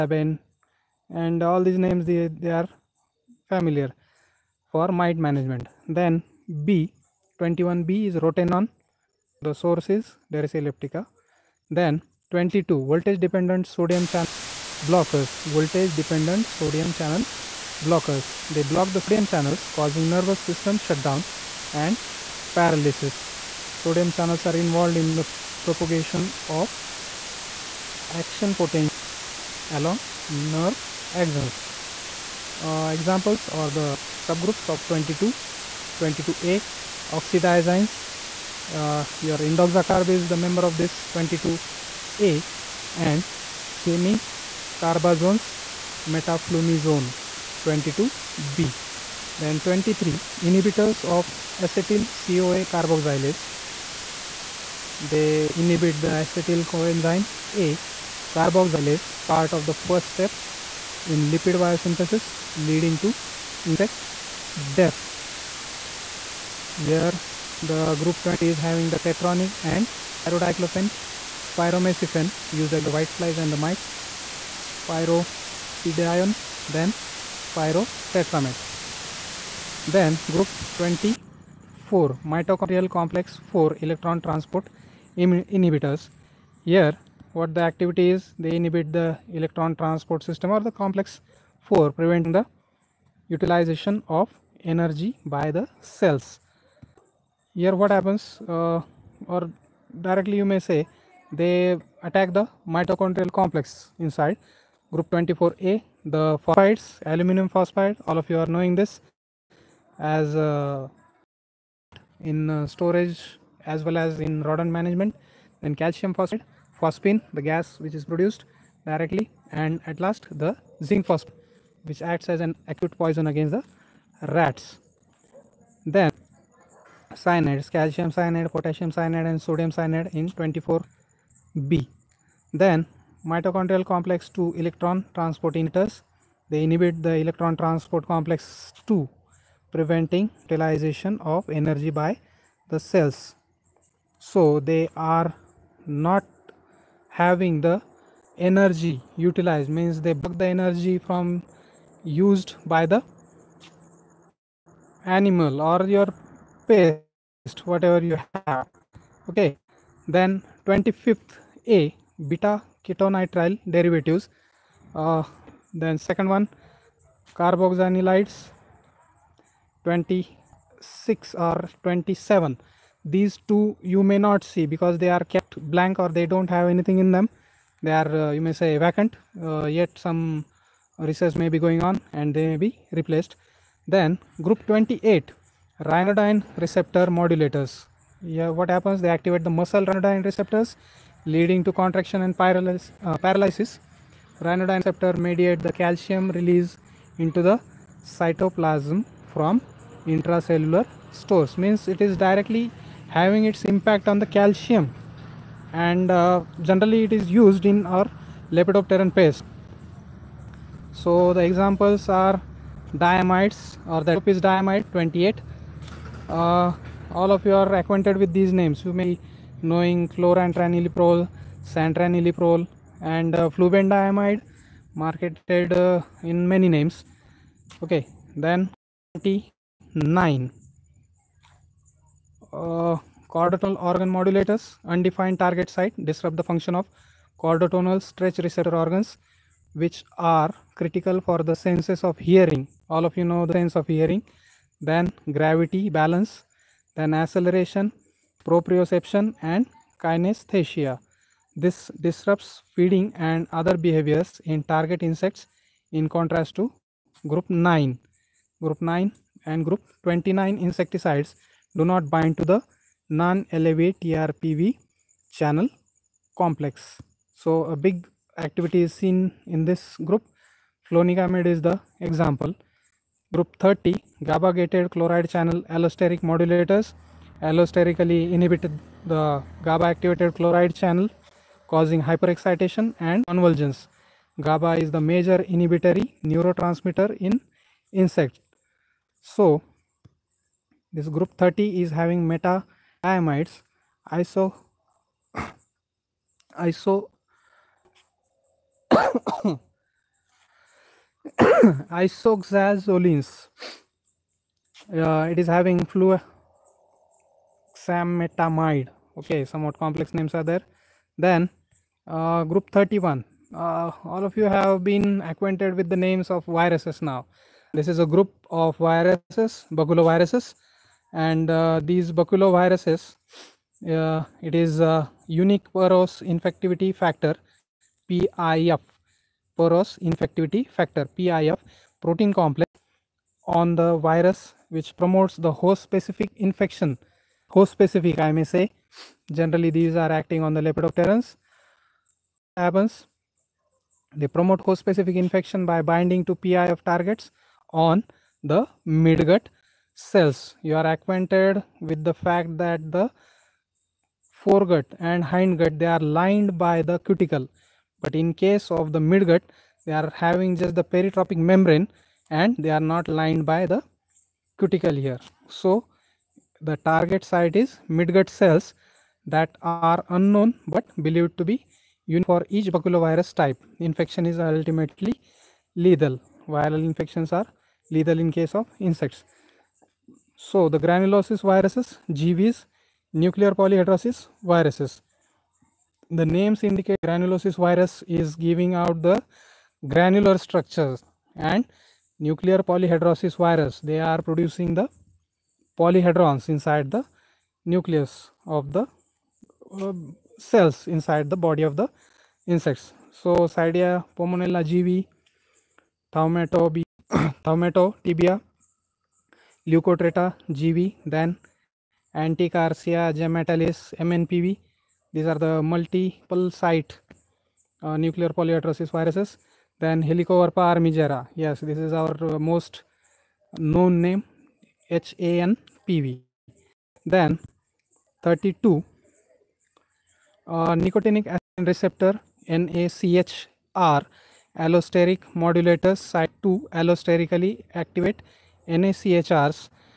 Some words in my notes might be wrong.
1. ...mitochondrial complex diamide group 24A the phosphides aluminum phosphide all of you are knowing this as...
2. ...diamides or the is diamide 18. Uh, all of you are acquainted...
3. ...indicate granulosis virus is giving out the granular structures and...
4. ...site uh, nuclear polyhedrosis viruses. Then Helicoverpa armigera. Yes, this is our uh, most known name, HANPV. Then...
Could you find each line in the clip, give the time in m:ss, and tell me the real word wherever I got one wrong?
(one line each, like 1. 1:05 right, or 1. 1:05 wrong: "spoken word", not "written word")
1. 1:42 wrong: "inside", not "diamide"
2. 3:32 wrong: "28", not "18"
3. 6:26 right
4. 6:56 right.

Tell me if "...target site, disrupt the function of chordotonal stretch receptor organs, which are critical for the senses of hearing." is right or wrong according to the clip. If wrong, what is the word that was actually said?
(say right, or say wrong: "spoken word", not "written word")
right.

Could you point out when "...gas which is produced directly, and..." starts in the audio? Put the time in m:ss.
1:57.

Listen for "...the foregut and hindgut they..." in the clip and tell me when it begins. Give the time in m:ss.
5:52.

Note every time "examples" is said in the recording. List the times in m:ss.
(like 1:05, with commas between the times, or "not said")
0:32, 3:31, 4:31.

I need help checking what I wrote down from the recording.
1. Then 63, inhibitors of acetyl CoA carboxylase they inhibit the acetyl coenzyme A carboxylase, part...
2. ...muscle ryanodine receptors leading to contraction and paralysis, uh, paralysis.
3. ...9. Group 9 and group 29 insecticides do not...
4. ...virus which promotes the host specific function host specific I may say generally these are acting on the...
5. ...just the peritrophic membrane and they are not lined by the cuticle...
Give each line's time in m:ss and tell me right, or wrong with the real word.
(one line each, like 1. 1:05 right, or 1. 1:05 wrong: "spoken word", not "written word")
1. 0:49 wrong: "23", not "63"
2. 3:09 right
3. 4:17 right
4. 5:33 wrong: "infection", not "function"
5. 6:00 right.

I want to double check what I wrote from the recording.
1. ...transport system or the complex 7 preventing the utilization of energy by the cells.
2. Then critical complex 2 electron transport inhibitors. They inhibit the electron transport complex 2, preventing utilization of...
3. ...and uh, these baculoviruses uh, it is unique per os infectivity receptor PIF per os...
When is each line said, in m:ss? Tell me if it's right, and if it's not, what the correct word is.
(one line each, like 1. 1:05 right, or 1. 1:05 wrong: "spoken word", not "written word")
1. 1:29 wrong: "4", not "7"
2. 2:12 wrong: "mitochondrial", not "critical"
3. 5:21 wrong: "factor", not "receptor".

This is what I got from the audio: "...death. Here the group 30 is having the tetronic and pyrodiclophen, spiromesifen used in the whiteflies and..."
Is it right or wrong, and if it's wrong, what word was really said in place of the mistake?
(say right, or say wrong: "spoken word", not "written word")
wrong: "20", not "30".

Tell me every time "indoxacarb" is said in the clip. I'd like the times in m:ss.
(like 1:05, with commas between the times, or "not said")
0:39.